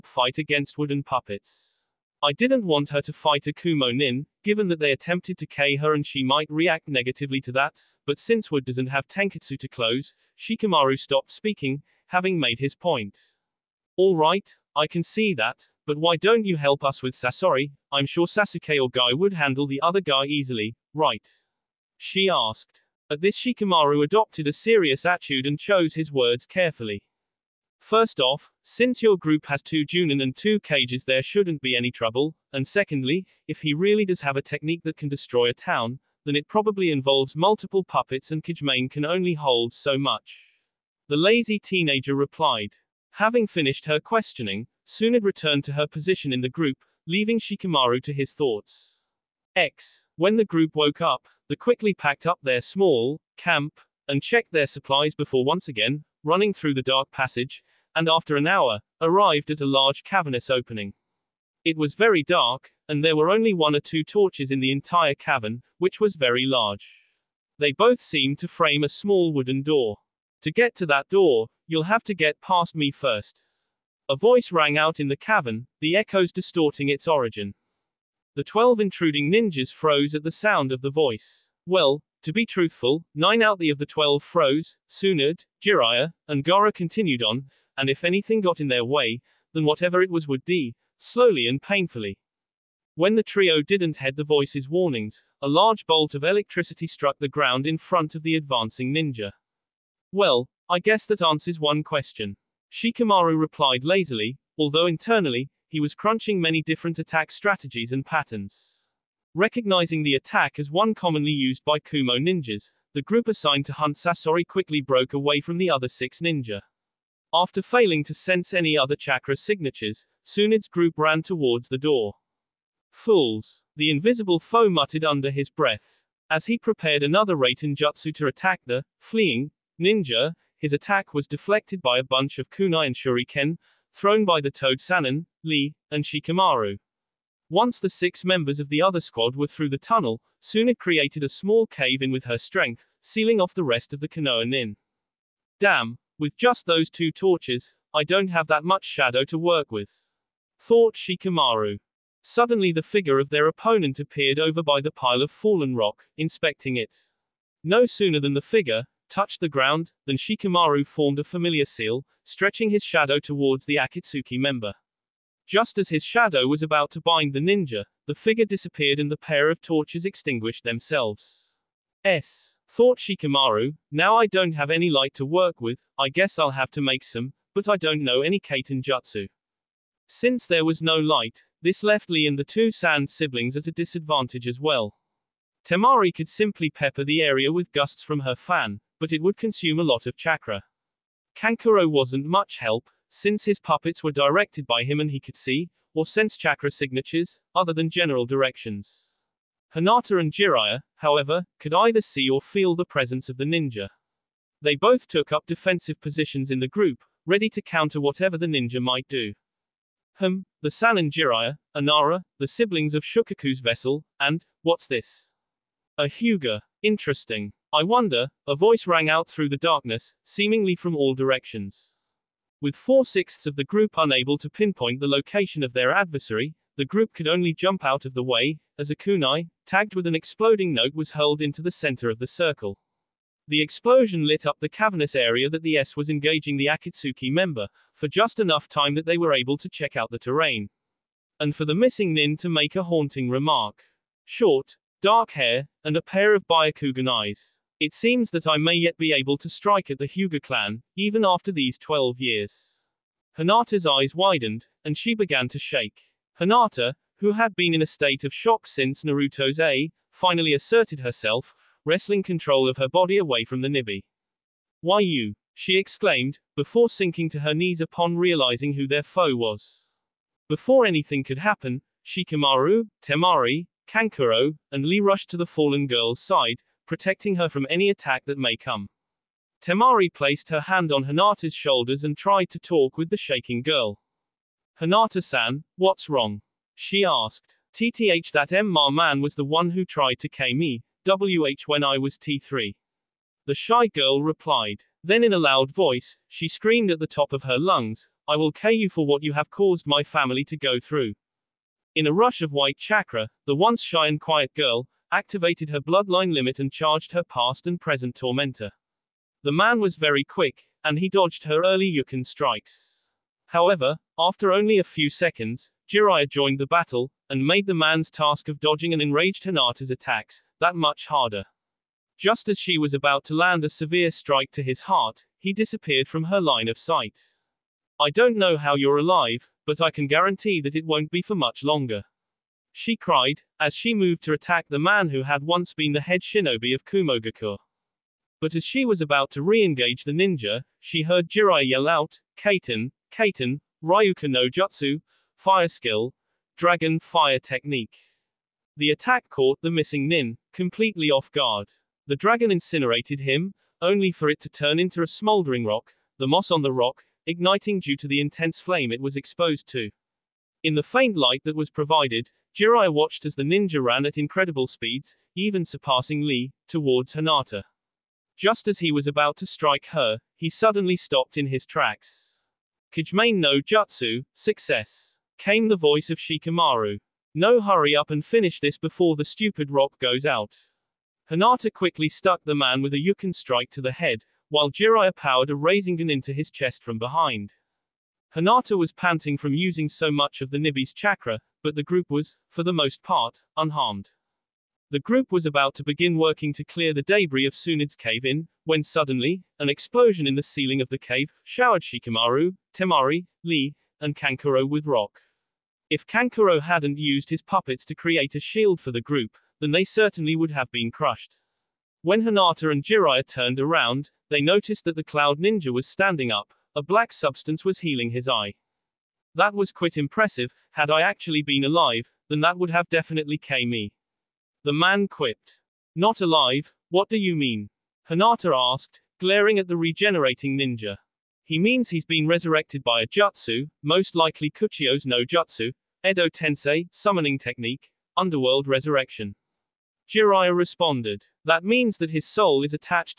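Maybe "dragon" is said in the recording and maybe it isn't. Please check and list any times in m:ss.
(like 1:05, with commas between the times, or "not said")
5:46, 5:52.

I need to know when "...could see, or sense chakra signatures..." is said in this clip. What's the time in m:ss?
3:15.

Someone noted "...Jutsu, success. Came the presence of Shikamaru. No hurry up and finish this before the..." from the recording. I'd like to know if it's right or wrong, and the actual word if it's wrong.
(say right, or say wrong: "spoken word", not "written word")
wrong: "voice", not "presence".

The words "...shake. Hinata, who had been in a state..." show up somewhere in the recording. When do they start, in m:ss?
4:15.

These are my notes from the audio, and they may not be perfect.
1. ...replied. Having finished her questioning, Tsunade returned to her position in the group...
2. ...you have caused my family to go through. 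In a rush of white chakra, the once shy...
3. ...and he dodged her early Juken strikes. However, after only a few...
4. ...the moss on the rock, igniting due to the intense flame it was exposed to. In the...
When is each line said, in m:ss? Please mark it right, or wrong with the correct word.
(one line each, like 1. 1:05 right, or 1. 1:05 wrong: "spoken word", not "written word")
1. 0:42 right
2. 4:59 right
3. 5:10 right
4. 5:56 right.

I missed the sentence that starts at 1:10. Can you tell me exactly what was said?
To get to that door, you'll have to get past me first.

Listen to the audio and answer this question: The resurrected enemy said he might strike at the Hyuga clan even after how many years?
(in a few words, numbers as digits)
12.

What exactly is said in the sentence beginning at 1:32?
When the trio didn't heed the voice's warnings, a large bolt of electricity struck the ground in front of the advancing ninja.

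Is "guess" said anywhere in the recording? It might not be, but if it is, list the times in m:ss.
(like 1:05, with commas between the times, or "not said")
1:40, 2:56.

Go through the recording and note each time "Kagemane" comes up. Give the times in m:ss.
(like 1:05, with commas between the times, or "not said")
0:38, 6:12.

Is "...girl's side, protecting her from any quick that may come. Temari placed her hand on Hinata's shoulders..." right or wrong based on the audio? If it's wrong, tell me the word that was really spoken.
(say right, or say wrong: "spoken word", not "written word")
wrong: "attack", not "quick".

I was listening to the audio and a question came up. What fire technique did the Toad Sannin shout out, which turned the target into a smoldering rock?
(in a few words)
Ryuka no Jutsu.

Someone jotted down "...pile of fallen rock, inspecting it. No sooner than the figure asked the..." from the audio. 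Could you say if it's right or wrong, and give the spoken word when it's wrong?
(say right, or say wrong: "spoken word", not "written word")
wrong: "touched", not "asked".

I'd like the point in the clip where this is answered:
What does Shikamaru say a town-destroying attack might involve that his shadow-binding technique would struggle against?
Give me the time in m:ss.
0:37.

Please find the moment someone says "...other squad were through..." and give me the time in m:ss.
2:18.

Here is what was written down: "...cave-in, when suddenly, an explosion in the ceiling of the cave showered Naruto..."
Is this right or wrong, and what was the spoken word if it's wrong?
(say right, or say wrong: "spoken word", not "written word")
wrong: "Shikamaru", not "Naruto".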